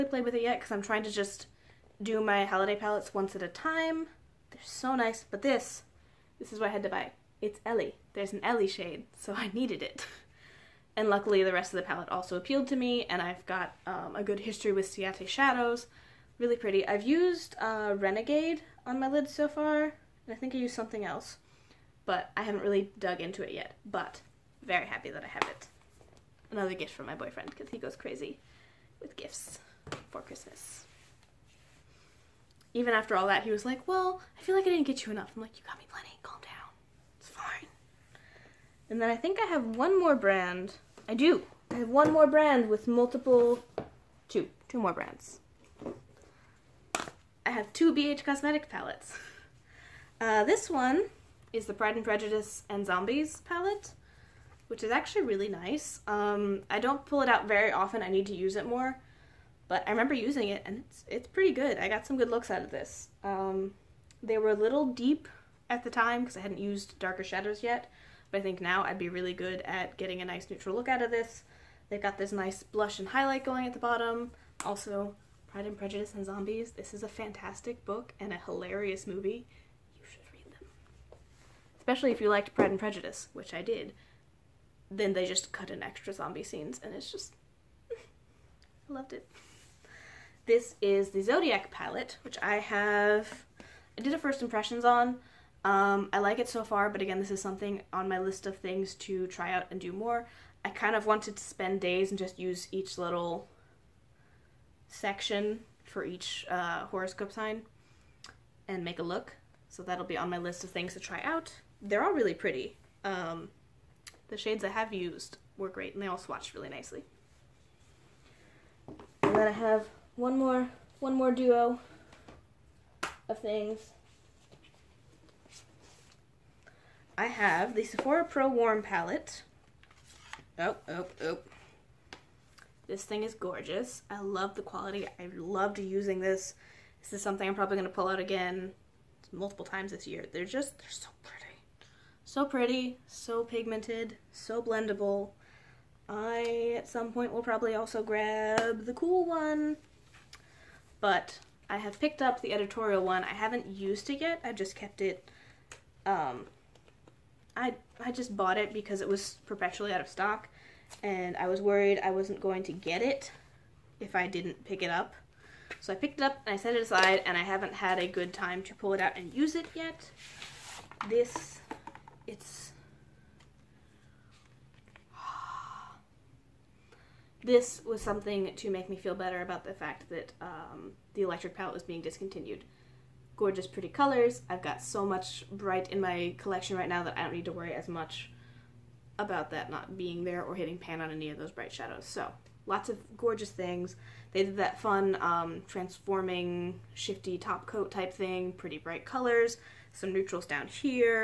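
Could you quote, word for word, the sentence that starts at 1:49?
So that'll be on my list of things to try out.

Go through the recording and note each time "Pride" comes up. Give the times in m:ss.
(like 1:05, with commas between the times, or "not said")
0:51, 1:15, 1:22.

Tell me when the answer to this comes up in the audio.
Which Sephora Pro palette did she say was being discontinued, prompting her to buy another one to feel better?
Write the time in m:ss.
3:01.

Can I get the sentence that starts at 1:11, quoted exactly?
They've got this nice blush and highlight going at the bottom.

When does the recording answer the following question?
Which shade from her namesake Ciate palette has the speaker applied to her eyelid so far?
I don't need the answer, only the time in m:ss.
0:17.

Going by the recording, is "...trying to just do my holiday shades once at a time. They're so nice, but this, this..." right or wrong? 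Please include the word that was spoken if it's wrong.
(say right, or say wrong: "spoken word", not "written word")
wrong: "palettes", not "shades".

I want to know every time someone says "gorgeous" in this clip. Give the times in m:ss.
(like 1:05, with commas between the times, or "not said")
2:13, 3:03, 3:13.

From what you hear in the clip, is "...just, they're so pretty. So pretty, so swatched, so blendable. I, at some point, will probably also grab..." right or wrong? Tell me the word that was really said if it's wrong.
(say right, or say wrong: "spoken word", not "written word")
wrong: "pigmented", not "swatched".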